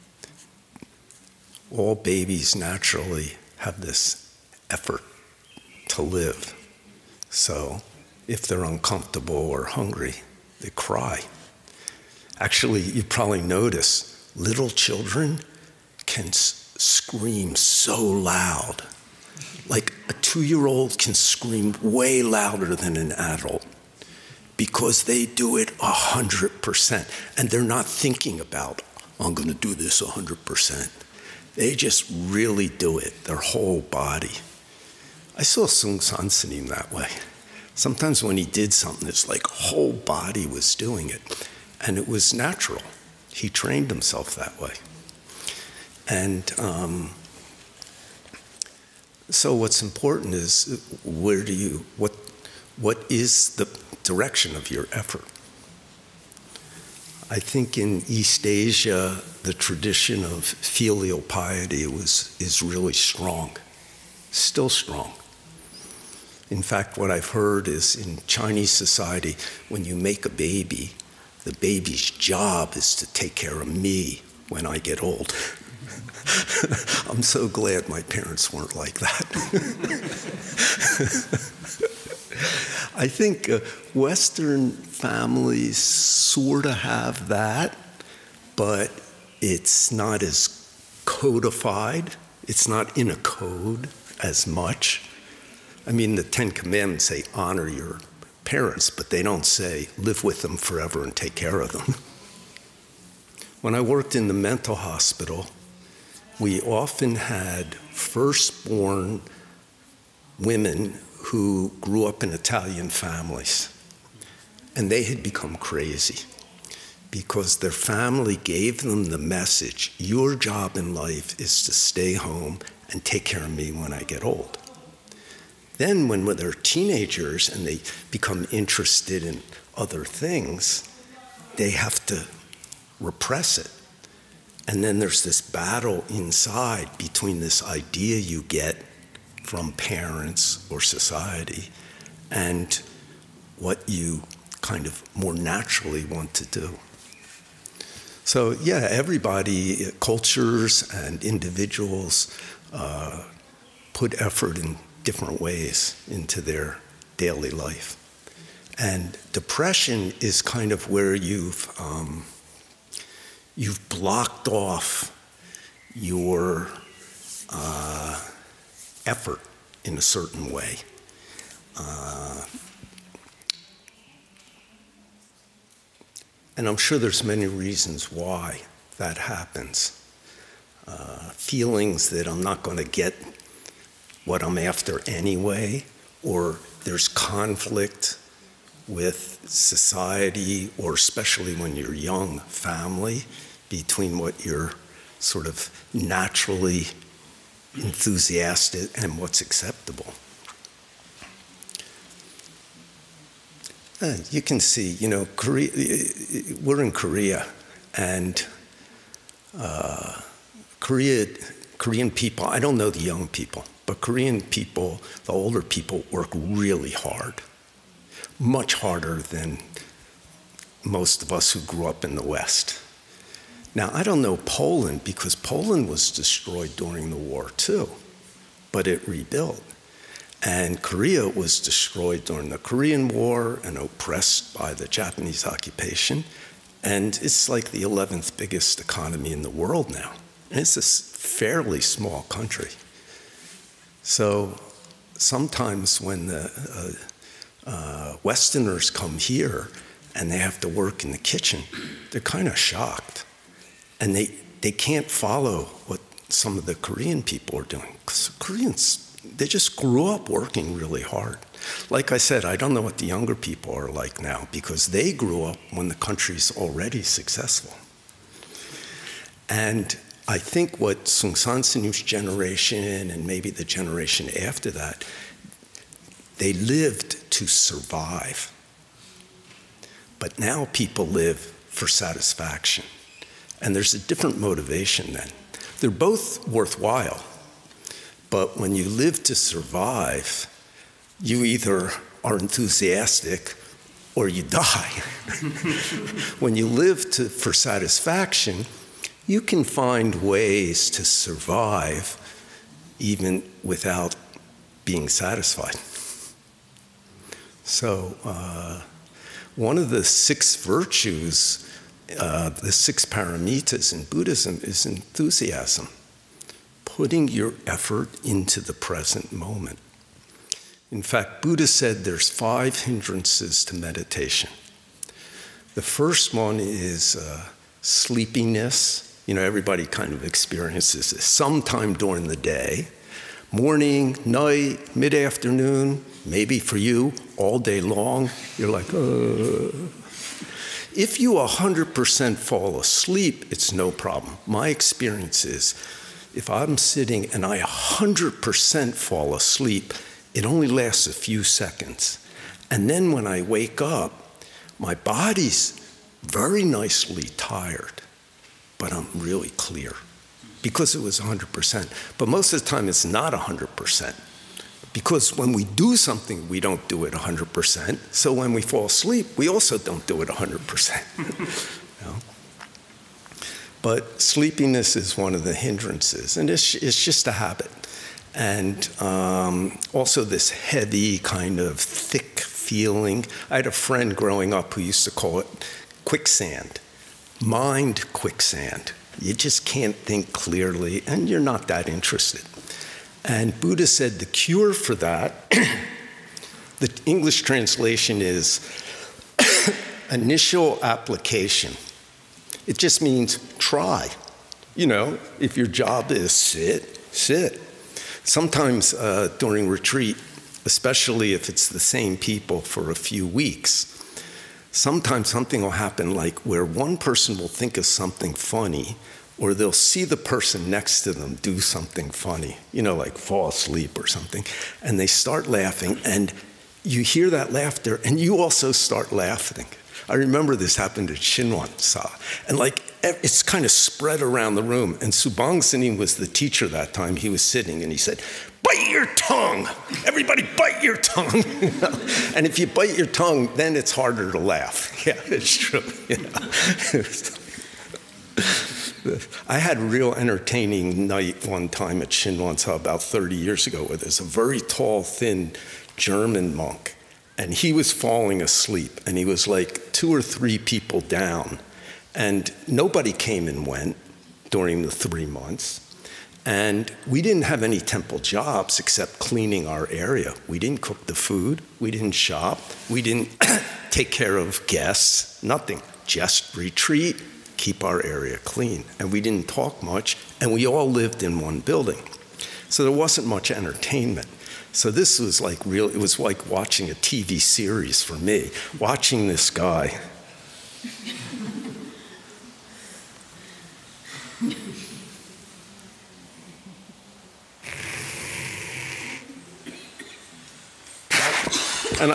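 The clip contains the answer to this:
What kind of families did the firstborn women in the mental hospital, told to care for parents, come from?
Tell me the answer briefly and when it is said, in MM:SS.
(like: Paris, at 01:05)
Italian, at 01:52.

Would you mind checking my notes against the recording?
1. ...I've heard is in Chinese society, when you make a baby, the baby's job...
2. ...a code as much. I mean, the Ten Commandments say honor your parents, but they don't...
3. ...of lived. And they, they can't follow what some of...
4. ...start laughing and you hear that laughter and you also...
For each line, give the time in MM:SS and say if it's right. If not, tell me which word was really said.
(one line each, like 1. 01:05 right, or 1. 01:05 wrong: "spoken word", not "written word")
1. 01:07 right
2. 01:33 right
3. 04:12 wrong: "shocked", not "lived"
4. 07:05 right.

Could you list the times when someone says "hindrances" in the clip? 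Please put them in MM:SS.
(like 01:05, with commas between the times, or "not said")
05:22, 06:15.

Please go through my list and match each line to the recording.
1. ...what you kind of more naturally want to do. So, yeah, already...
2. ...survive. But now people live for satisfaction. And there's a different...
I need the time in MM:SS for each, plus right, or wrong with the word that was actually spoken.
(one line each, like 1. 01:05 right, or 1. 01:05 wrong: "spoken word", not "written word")
1. 02:23 wrong: "everybody", not "already"
2. 04:37 right.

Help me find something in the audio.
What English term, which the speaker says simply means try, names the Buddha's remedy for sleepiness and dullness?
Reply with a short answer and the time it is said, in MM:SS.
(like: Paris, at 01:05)
initial application, at 06:40.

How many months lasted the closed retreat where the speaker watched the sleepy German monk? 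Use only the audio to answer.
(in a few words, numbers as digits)
3.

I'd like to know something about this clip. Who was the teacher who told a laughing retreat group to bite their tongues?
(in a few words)
Su Bong Sunim.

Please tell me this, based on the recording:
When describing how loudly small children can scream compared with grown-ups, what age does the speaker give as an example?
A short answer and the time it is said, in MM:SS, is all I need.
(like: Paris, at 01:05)
2, at 00:20.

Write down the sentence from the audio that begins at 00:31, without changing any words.
They just really do it, their whole body.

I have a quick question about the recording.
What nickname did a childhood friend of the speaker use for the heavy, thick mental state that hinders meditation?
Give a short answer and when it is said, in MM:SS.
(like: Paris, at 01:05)
quicksand mind, at 06:26.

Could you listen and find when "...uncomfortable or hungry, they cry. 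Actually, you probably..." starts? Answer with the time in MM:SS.
00:08.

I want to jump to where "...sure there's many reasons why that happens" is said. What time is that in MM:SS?
02:56.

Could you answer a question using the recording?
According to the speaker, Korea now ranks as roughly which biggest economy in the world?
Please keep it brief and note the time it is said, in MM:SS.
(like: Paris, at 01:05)
11th, at 03:57.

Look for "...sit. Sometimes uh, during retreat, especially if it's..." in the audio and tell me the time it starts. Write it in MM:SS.
06:47.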